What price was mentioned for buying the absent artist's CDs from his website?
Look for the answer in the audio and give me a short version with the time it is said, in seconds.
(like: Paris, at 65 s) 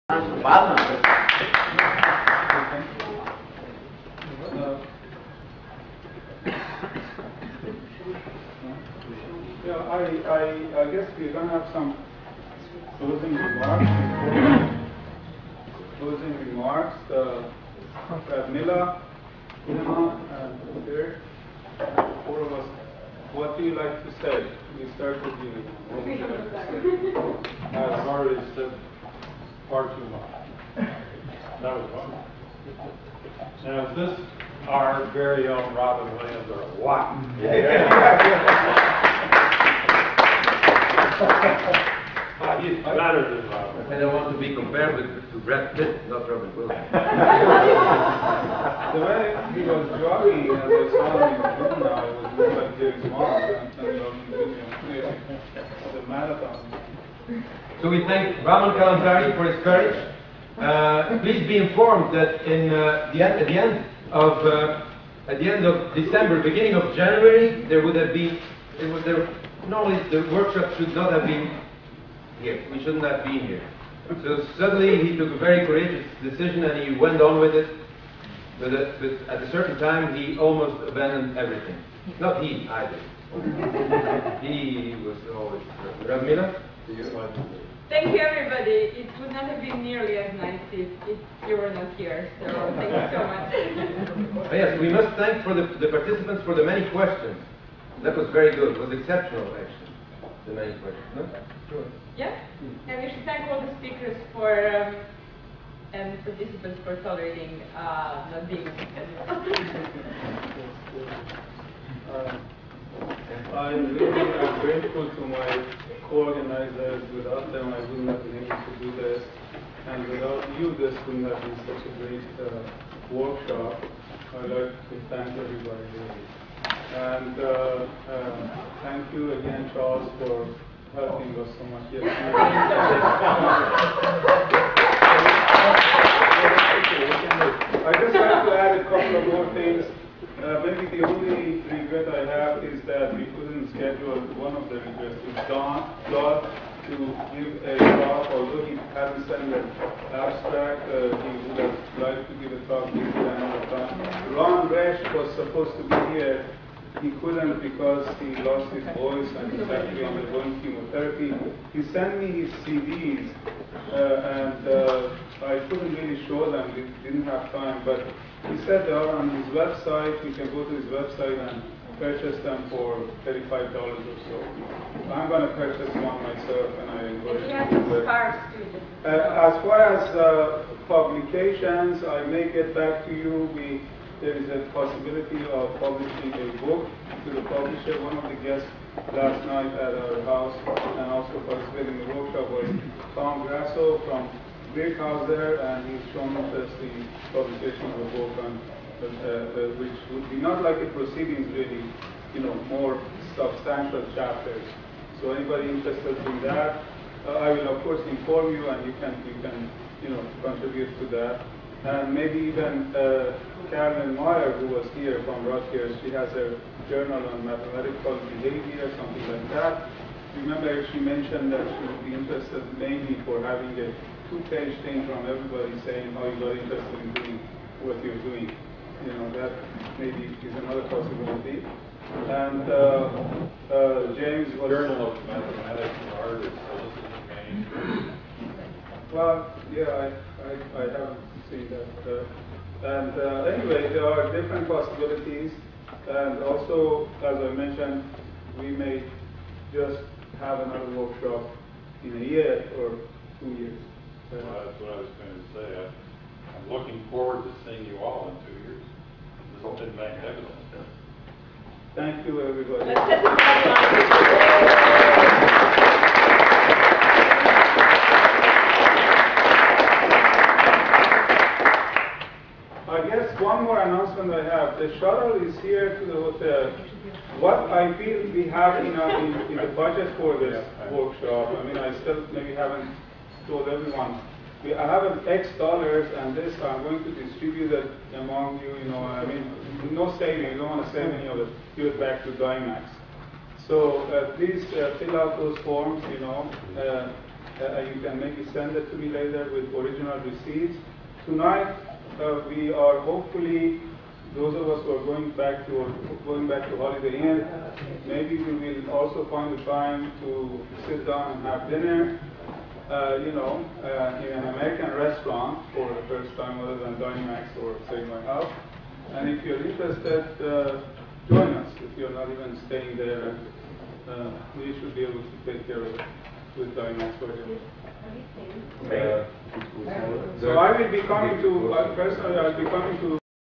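$35, at 173 s.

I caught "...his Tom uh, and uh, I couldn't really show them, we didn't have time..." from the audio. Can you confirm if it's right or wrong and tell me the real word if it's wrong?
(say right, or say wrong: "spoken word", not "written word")
wrong: "CDs", not "Tom".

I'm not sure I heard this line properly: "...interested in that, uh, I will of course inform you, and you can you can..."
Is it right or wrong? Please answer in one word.
right.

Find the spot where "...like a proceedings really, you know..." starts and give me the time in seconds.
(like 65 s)
200 s.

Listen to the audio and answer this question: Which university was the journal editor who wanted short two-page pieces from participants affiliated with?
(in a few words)
Rutgers.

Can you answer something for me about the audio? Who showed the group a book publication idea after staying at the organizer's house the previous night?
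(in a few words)
Tom Grasso.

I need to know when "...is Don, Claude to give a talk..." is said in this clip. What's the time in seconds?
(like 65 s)
145 s.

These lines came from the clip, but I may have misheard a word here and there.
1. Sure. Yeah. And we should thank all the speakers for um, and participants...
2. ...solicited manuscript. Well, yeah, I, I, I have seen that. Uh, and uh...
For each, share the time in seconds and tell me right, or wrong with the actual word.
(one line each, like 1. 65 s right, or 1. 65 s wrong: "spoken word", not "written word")
1. 101 s right
2. 236 s right.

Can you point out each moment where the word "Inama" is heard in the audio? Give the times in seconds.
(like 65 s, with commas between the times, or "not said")
19 s.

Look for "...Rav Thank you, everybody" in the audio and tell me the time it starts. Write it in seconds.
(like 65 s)
86 s.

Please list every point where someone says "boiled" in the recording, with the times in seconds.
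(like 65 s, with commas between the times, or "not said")
not said.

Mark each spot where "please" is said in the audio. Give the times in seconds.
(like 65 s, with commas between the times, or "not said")
61 s, 294 s.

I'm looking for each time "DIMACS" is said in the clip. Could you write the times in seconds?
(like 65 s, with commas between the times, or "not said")
292 s, 316 s, 326 s.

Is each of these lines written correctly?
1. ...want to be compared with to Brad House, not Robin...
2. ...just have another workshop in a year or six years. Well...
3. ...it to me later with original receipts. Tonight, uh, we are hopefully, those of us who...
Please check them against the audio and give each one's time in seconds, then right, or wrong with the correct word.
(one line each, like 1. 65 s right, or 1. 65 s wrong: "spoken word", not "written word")
1. 44 s wrong: "Pitt", not "House"
2. 249 s wrong: "two", not "six"
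3. 298 s right.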